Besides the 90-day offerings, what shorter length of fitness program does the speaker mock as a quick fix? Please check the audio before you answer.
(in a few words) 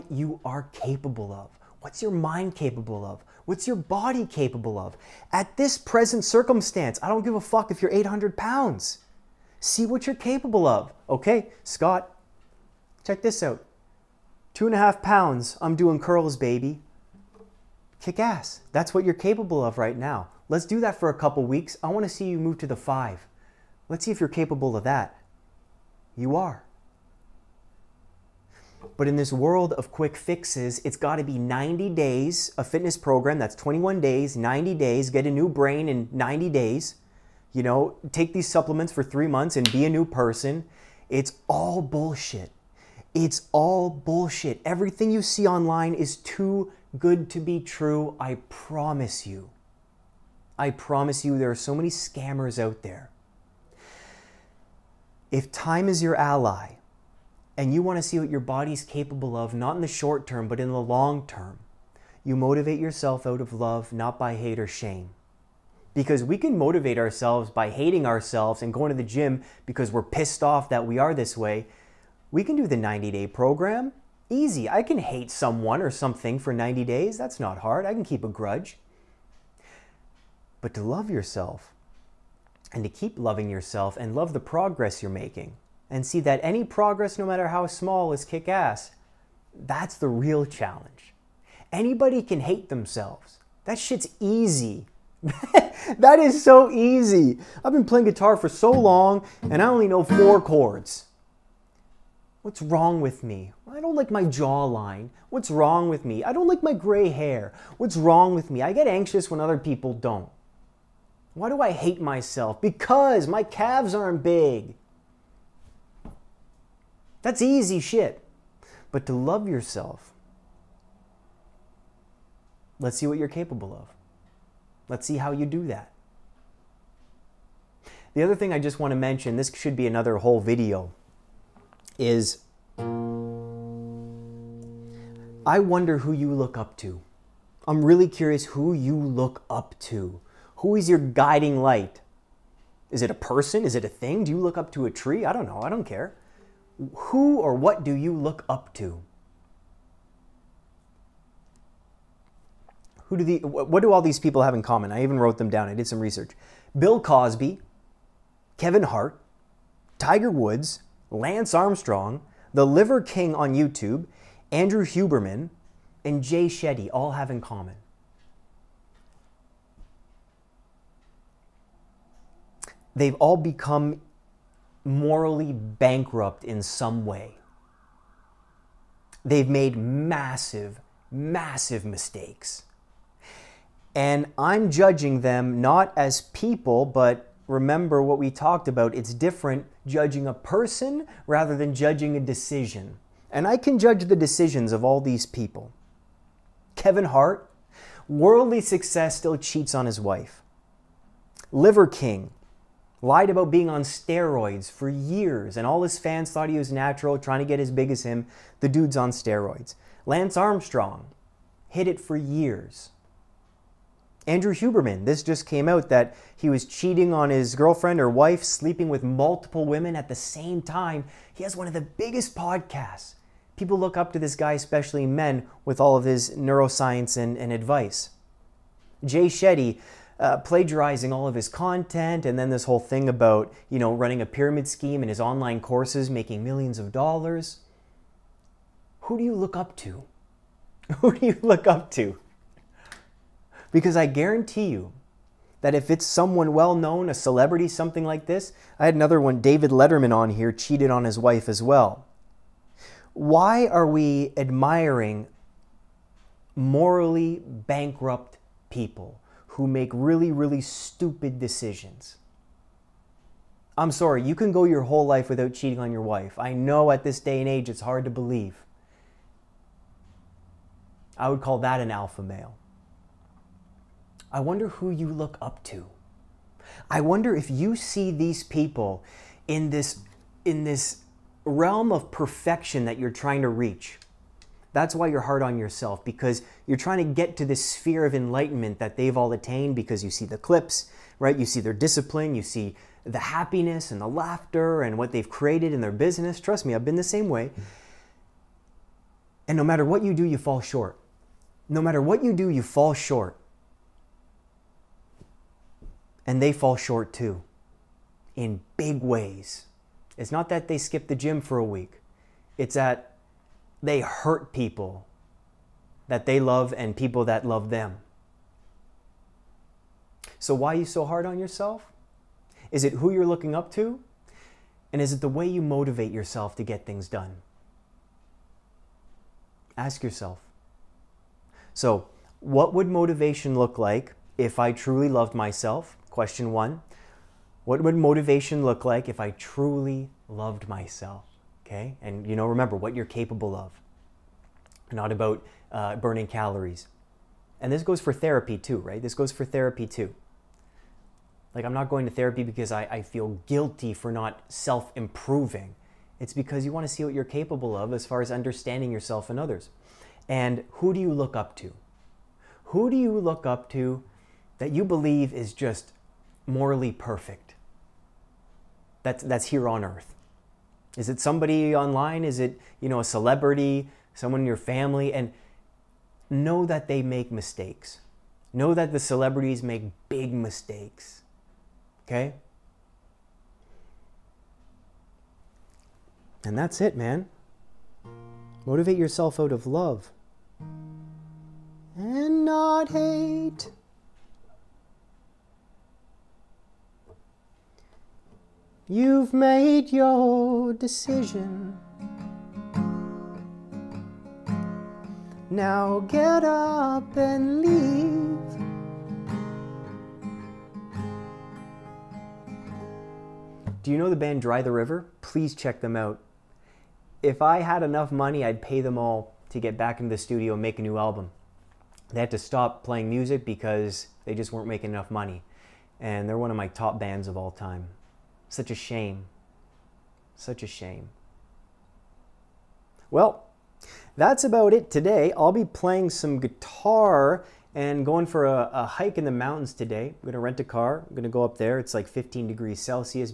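21 days.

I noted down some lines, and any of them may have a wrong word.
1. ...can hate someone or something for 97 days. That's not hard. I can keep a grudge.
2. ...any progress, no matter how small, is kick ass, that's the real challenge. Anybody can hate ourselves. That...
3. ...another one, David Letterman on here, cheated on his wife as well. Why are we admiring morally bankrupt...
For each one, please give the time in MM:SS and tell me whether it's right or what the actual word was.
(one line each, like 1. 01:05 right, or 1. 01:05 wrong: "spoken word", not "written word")
1. 01:14 wrong: "90", not "97"
2. 01:26 wrong: "themselves", not "ourselves"
3. 04:08 right.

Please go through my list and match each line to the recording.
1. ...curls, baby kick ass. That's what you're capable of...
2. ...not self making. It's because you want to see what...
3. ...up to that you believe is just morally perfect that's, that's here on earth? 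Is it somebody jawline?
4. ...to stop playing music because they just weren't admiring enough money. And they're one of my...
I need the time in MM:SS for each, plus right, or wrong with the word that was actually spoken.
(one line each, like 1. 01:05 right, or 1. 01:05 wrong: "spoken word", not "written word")
1. 00:15 right
2. 05:54 wrong: "improving", not "making"
3. 06:03 wrong: "online", not "jawline"
4. 07:02 wrong: "making", not "admiring".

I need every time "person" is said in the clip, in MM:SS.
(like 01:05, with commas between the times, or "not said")
00:40, 02:23, 03:10.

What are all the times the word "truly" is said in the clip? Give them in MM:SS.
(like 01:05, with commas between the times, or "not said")
05:34, 05:39.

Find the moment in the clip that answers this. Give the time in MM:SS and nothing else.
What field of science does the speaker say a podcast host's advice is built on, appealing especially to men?
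03:46.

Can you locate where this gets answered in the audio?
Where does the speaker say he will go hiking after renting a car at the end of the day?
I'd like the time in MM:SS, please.
07:19.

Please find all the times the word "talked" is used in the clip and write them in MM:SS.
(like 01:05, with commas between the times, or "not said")
03:08.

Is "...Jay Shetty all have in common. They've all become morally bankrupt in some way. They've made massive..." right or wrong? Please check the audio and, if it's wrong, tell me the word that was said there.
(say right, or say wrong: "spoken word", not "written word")
right.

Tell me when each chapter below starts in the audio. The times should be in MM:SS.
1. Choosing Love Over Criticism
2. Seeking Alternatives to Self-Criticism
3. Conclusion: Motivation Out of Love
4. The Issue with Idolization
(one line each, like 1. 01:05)
1. 04:13
2. 00:58
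3. 05:58
4. 02:43.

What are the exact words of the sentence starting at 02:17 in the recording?
I'm really curious who you look up to.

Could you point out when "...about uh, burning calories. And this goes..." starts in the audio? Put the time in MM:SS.
05:45.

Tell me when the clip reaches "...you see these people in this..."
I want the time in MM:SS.
04:37.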